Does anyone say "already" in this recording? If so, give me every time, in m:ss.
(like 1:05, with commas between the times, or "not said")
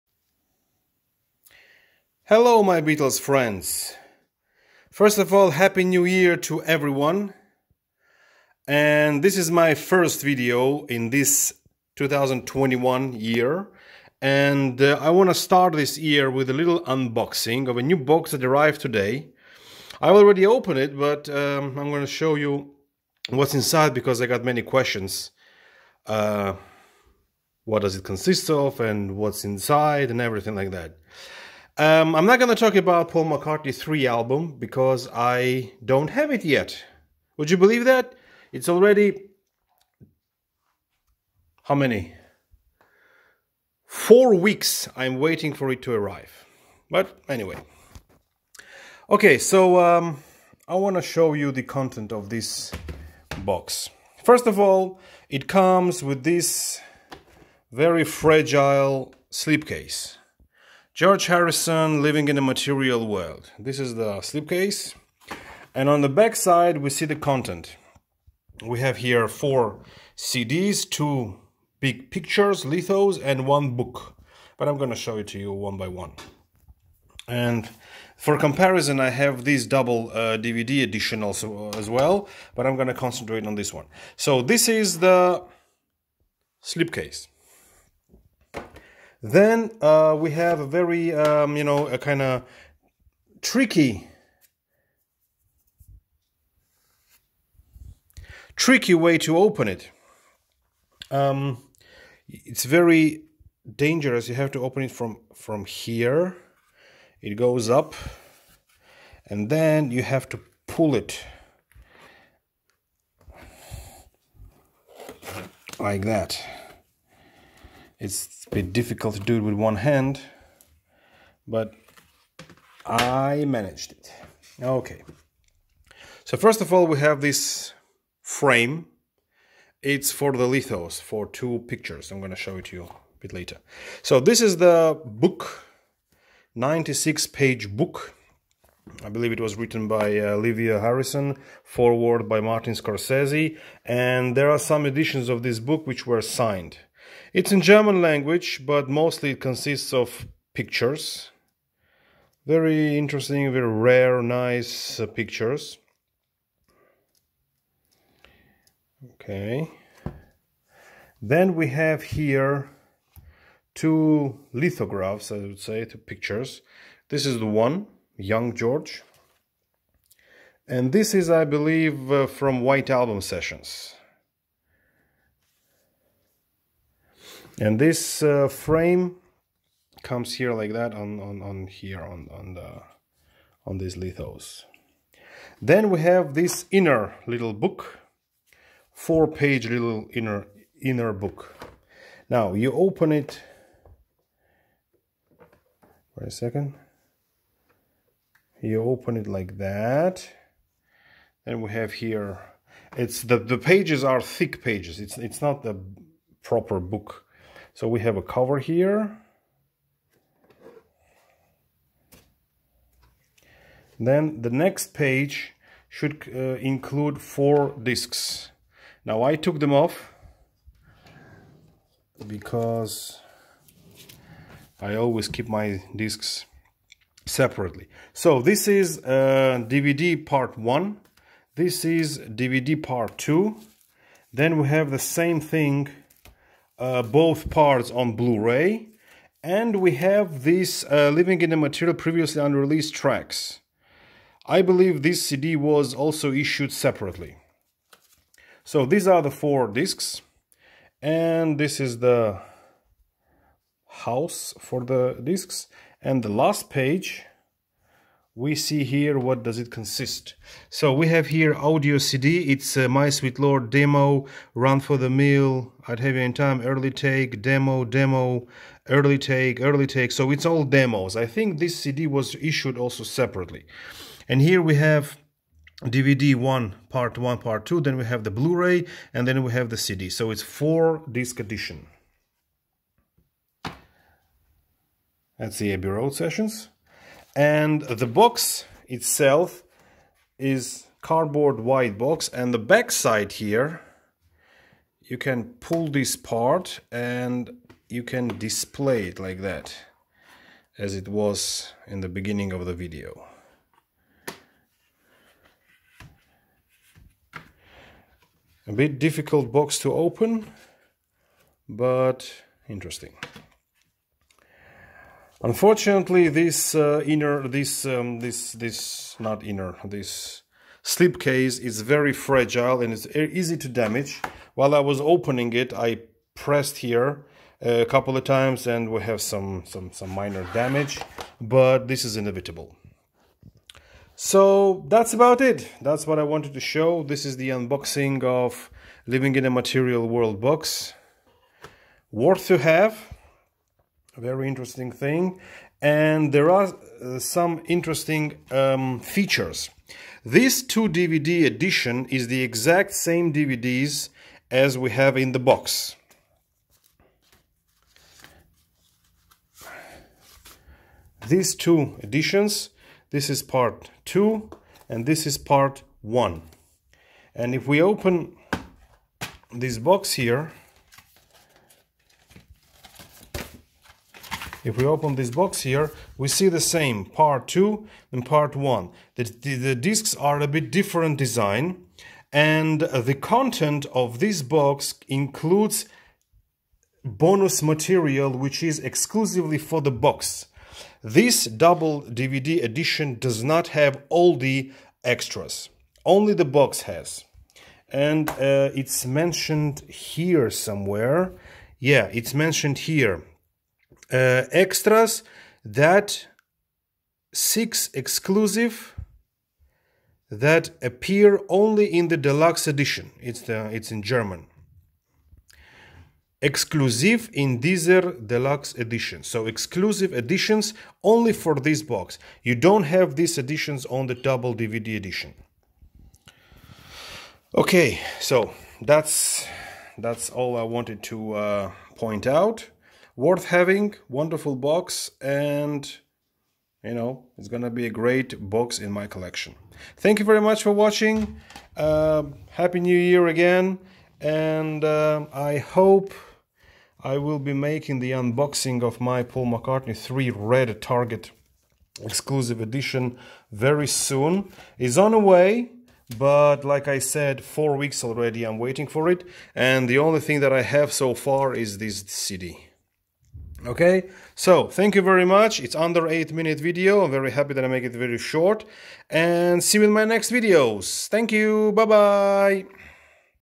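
0:20, 0:38, 7:38.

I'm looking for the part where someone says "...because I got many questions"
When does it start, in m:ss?
0:23.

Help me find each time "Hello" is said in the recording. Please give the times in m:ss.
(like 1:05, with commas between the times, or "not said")
0:02.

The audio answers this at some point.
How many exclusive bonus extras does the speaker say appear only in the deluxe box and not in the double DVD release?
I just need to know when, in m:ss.
6:47.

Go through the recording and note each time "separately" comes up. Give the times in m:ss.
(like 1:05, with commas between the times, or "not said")
3:47, 4:06, 4:33.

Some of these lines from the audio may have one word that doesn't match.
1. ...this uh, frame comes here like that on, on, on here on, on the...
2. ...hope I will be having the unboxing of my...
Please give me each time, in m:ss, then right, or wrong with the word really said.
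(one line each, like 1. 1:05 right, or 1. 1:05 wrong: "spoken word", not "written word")
1. 2:57 right
2. 7:25 wrong: "making", not "having".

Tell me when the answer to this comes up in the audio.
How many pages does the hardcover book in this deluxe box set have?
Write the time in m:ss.
2:16.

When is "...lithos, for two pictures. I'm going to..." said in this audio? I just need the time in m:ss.
2:10.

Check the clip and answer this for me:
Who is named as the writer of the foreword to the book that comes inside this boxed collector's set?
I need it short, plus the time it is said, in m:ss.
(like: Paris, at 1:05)
Martin Scorsese, at 2:22.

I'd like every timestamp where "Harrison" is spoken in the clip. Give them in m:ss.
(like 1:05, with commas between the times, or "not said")
1:01, 2:20.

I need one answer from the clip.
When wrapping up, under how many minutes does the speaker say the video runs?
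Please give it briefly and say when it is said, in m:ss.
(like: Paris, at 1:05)
8, at 7:46.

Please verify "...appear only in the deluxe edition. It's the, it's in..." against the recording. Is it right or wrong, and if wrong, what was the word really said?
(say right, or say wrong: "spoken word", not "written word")
right.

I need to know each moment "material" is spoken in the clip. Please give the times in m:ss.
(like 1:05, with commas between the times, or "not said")
1:02, 4:01, 5:39, 6:27.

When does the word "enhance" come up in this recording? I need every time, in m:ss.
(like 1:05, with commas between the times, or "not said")
not said.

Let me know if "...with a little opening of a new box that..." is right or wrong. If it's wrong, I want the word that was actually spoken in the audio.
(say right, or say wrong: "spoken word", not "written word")
wrong: "unboxing", not "opening".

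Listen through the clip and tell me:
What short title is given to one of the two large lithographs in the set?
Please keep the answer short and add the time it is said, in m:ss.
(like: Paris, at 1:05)
Young George, at 2:48.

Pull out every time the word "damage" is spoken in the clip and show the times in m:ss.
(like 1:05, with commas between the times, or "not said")
5:23, 5:30.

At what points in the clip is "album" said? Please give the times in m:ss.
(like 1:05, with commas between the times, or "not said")
0:34, 2:52.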